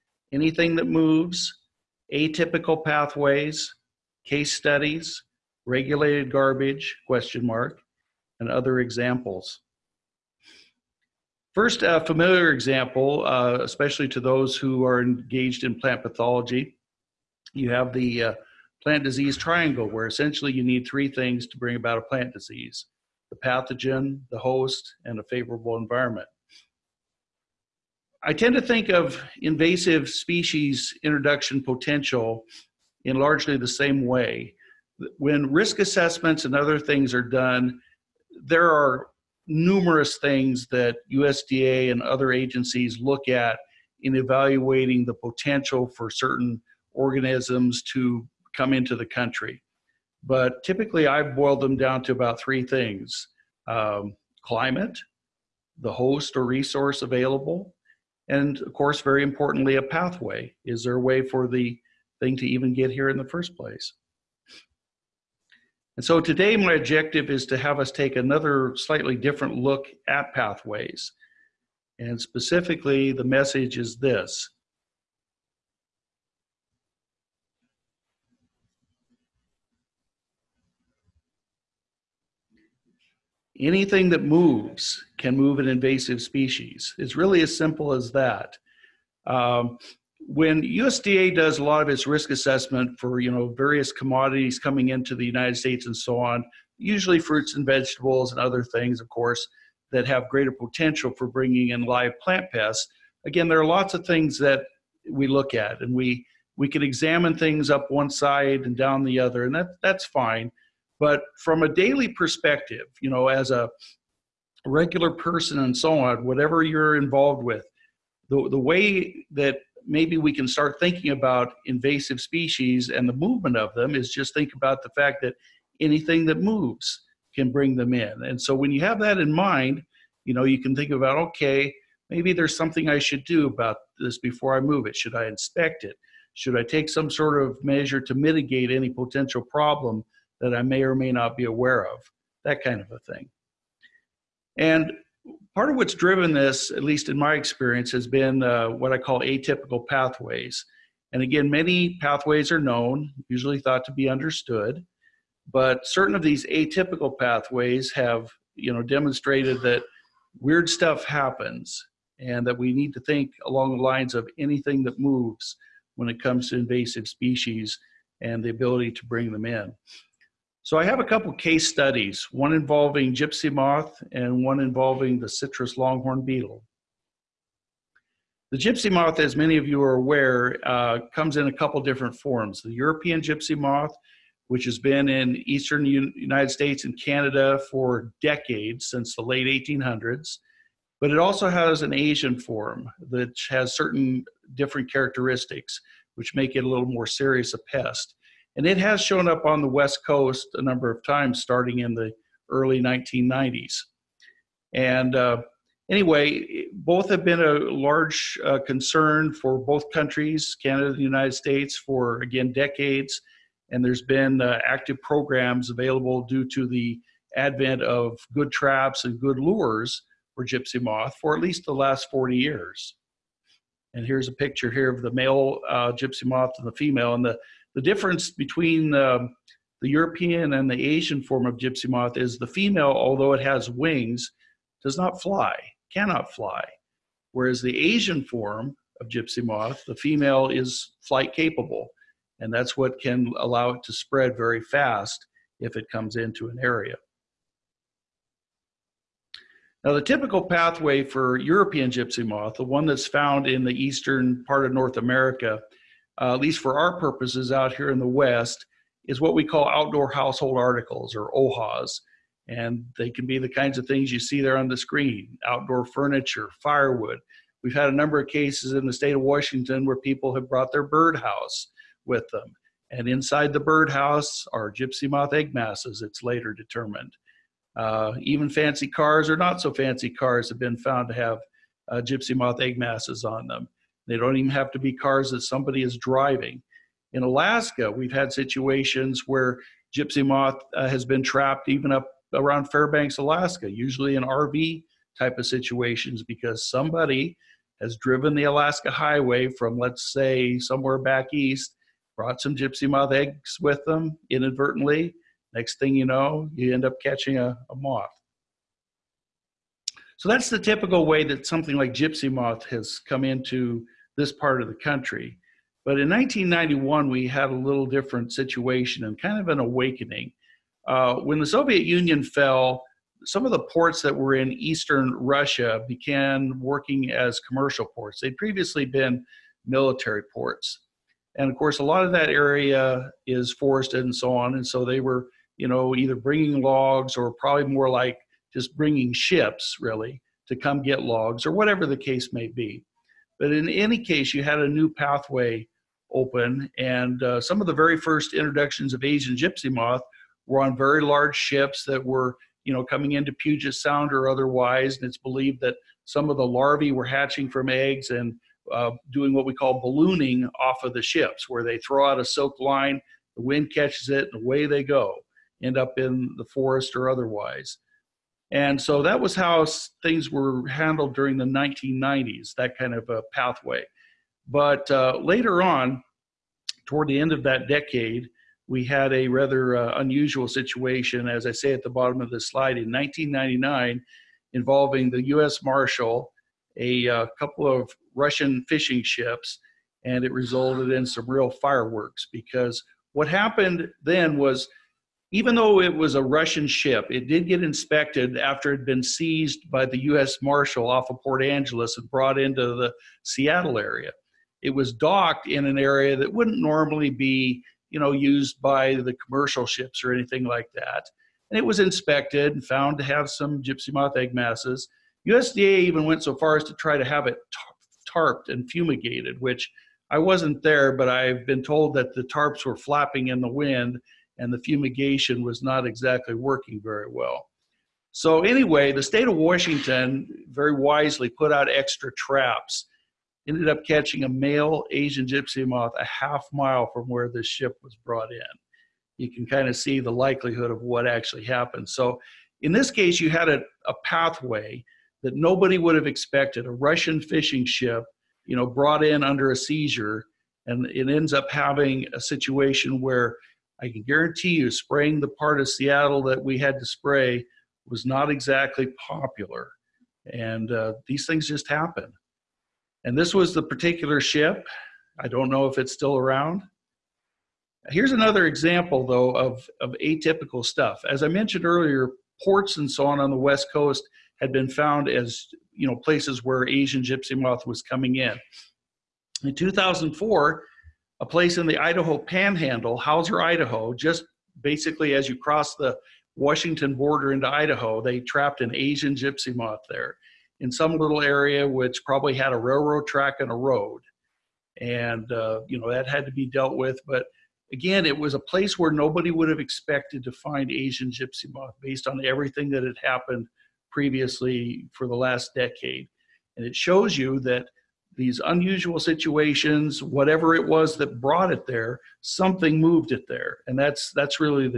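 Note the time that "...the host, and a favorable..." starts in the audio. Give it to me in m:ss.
0:24.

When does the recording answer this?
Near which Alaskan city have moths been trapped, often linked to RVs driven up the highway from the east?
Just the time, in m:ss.
4:52.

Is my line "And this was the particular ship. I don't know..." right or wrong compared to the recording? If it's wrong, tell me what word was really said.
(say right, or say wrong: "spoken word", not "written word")
right.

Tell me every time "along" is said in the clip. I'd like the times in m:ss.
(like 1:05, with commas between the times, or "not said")
2:43.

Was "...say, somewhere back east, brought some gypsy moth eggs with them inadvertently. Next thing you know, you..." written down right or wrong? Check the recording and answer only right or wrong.
right.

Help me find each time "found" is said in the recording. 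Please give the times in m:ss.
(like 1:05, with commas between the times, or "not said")
4:13, 4:40, 6:52, 7:54.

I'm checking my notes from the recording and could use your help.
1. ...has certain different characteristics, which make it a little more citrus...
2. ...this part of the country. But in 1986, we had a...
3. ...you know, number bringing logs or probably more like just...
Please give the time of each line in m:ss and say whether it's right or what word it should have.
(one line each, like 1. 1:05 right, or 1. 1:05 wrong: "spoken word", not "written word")
1. 3:13 wrong: "serious", not "citrus"
2. 5:14 wrong: "1991", not "1986"
3. 5:35 wrong: "either", not "number".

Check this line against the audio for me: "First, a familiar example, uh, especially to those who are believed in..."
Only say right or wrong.
wrong.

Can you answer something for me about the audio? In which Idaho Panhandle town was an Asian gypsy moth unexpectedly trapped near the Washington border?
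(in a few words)
Hauser.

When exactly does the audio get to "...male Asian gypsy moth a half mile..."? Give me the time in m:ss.
7:14.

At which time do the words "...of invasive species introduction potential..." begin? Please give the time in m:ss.
0:28.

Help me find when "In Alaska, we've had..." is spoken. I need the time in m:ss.
4:47.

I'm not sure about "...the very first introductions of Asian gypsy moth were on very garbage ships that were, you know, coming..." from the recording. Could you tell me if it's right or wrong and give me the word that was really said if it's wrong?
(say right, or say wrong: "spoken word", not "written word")
wrong: "large", not "garbage".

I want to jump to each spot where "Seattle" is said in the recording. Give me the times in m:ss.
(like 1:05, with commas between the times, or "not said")
6:43, 7:35.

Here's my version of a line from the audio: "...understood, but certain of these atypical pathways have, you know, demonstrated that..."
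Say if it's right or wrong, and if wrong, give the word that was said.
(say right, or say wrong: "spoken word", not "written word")
right.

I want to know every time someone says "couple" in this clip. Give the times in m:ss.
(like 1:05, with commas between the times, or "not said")
2:51, 3:01, 6:27.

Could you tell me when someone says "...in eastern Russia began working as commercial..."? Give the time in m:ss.
5:24.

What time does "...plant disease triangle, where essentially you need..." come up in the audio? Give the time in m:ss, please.
0:18.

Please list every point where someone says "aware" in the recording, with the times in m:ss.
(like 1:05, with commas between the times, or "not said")
2:21, 2:59.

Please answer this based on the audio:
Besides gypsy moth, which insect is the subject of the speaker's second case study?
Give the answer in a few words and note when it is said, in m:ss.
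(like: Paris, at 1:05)
citrus longhorn beetle, at 2:55.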